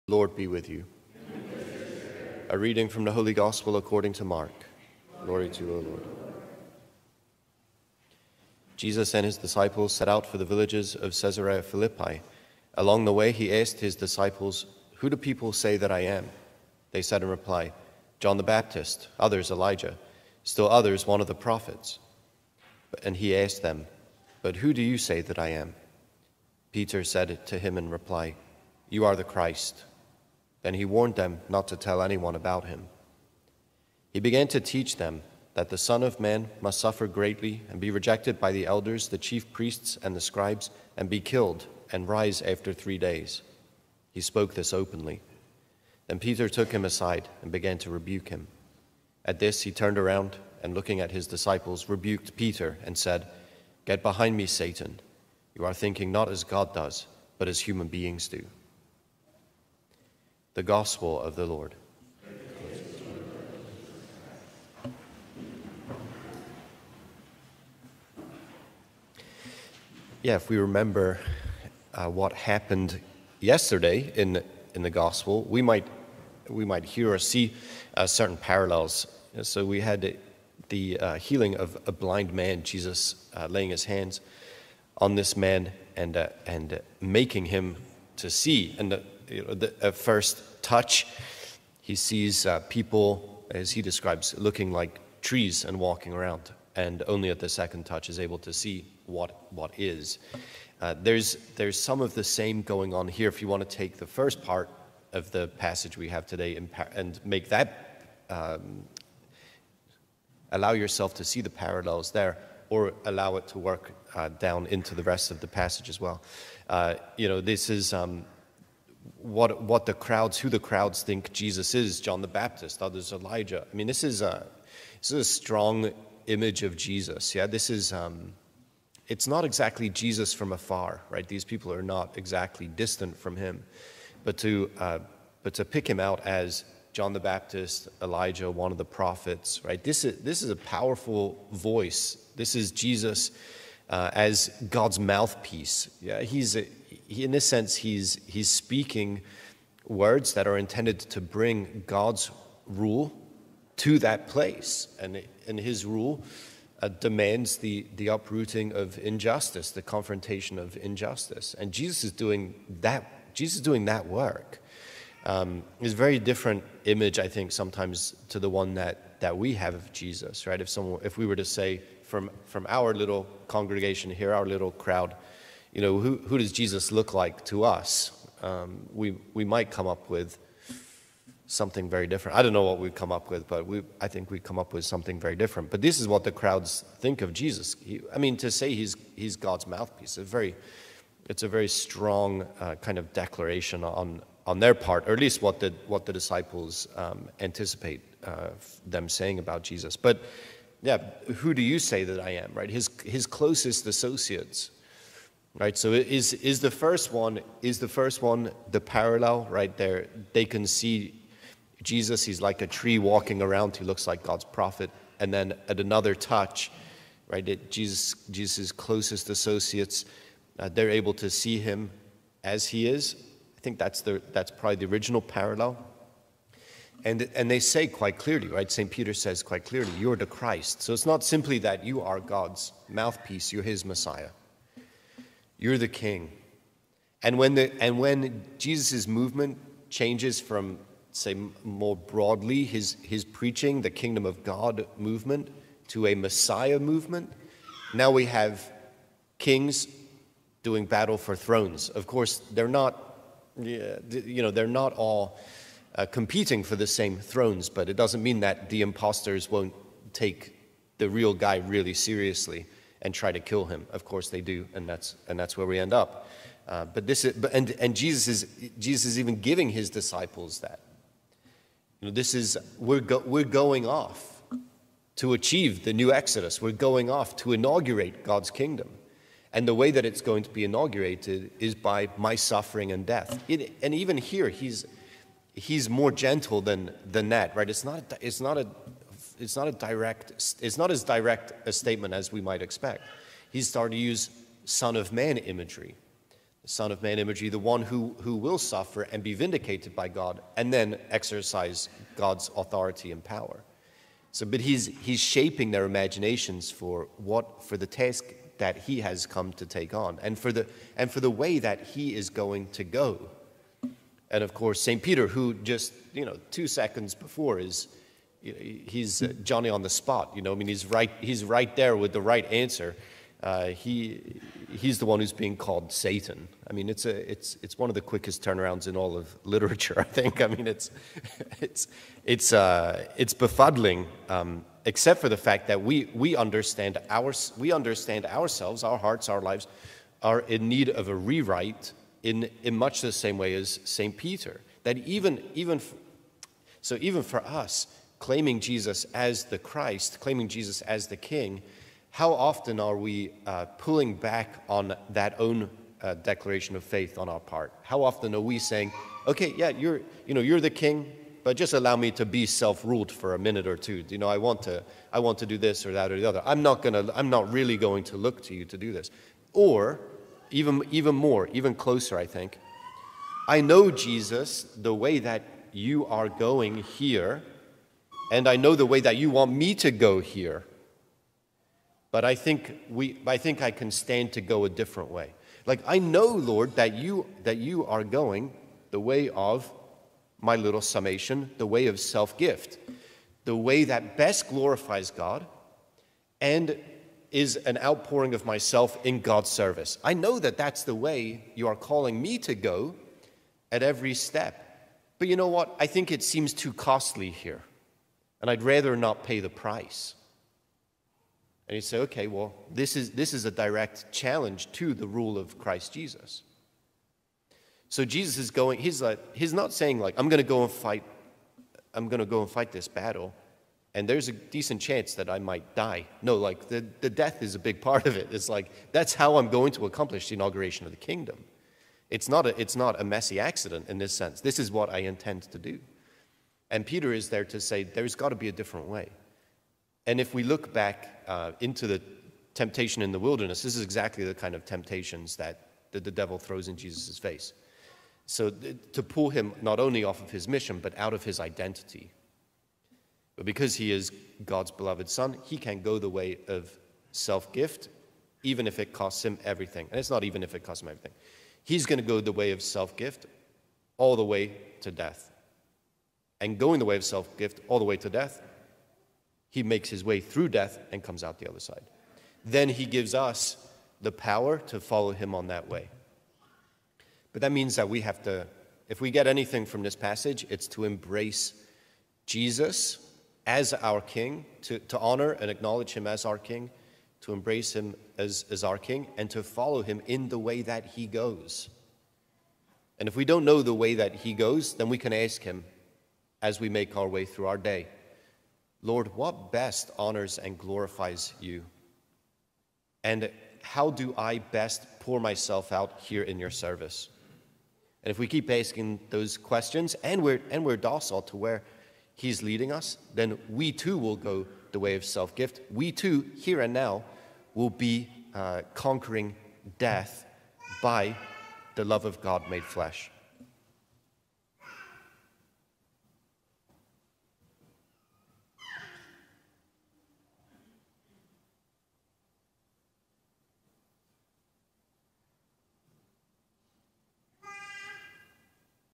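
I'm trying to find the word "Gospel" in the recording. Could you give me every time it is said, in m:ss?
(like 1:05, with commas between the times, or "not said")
0:03, 1:00, 1:14.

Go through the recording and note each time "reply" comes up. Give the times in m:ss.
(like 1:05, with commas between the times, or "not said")
0:17, 0:27.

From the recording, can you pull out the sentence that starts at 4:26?
Uh, but this is, but, and, and Jesus, is, Jesus is even giving his disciples that.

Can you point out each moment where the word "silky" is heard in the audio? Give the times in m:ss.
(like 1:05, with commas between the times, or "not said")
not said.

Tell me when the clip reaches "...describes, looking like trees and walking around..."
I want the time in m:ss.
1:33.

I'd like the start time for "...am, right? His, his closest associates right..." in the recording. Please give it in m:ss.
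3:22.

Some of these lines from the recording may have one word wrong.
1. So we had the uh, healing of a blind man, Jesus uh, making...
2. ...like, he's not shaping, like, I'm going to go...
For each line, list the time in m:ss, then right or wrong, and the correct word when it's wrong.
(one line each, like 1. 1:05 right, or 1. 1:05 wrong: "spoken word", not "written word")
1. 1:19 wrong: "laying", not "making"
2. 6:59 wrong: "saying", not "shaping".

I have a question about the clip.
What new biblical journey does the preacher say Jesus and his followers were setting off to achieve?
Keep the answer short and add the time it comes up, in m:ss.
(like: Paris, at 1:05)
The new Exodus, at 4:35.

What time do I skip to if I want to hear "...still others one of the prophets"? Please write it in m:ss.
0:20.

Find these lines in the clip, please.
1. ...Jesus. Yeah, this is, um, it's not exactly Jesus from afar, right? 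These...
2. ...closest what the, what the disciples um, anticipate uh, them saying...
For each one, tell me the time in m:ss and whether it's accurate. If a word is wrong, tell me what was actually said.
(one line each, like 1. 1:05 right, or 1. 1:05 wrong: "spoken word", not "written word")
1. 2:06 right
2. 3:15 wrong: "least", not "closest".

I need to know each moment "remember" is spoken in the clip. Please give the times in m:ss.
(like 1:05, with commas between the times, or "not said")
1:10.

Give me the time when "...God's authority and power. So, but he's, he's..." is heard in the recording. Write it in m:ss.
5:02.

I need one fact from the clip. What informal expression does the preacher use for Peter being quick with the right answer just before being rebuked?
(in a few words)
Johnny on the spot.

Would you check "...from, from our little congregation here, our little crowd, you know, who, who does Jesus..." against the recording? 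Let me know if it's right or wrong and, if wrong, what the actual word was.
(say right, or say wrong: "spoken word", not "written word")
right.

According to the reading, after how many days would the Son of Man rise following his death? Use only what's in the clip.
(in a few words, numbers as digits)
3.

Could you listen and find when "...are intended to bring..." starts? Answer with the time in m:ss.
2:30.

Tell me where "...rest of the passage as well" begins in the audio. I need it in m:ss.
1:55.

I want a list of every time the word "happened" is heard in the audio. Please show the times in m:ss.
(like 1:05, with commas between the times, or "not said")
1:12.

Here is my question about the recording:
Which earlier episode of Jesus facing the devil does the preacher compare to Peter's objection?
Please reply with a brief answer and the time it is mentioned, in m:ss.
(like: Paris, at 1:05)
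Temptation in the wilderness, at 7:22.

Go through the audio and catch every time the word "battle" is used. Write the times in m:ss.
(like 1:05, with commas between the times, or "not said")
4:10, 7:02.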